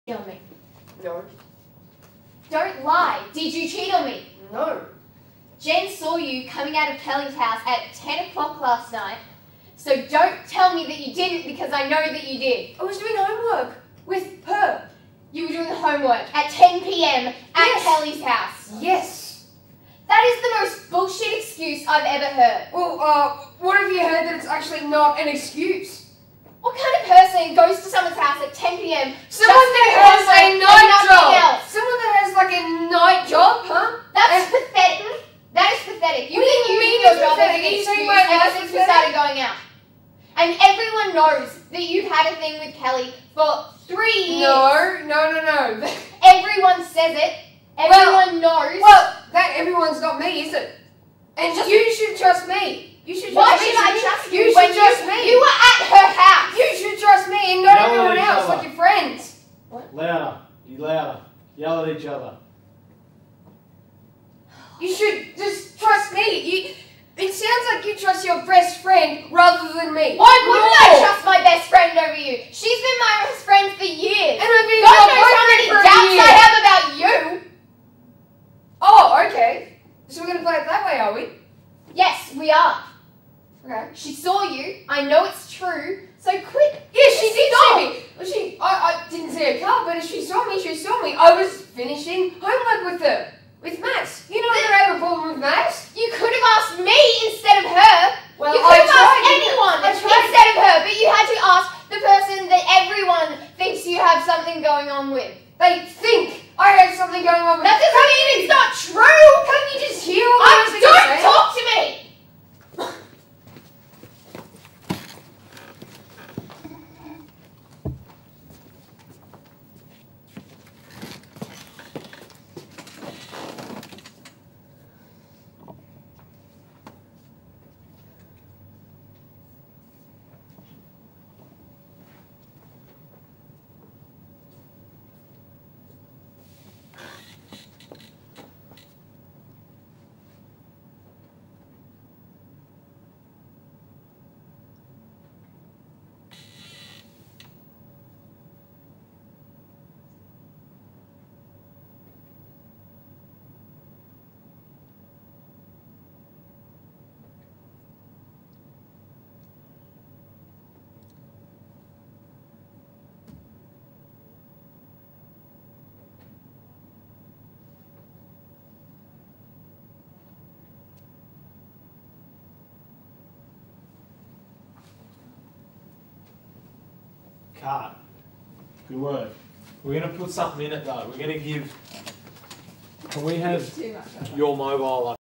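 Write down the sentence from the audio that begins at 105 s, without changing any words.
They think I have something going on with.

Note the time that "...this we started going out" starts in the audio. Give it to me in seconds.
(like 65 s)
38 s.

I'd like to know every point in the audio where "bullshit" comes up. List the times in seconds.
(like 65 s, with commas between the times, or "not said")
20 s.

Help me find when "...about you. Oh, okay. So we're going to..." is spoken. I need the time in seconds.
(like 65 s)
76 s.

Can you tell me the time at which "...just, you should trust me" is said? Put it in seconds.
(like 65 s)
51 s.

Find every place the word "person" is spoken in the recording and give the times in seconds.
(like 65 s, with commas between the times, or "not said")
27 s.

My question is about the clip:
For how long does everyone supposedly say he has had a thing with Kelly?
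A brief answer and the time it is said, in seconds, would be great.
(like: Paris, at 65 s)
3 years, at 43 s.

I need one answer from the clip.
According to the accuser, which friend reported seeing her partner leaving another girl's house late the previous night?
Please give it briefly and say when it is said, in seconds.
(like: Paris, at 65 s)
Jen, at 5 s.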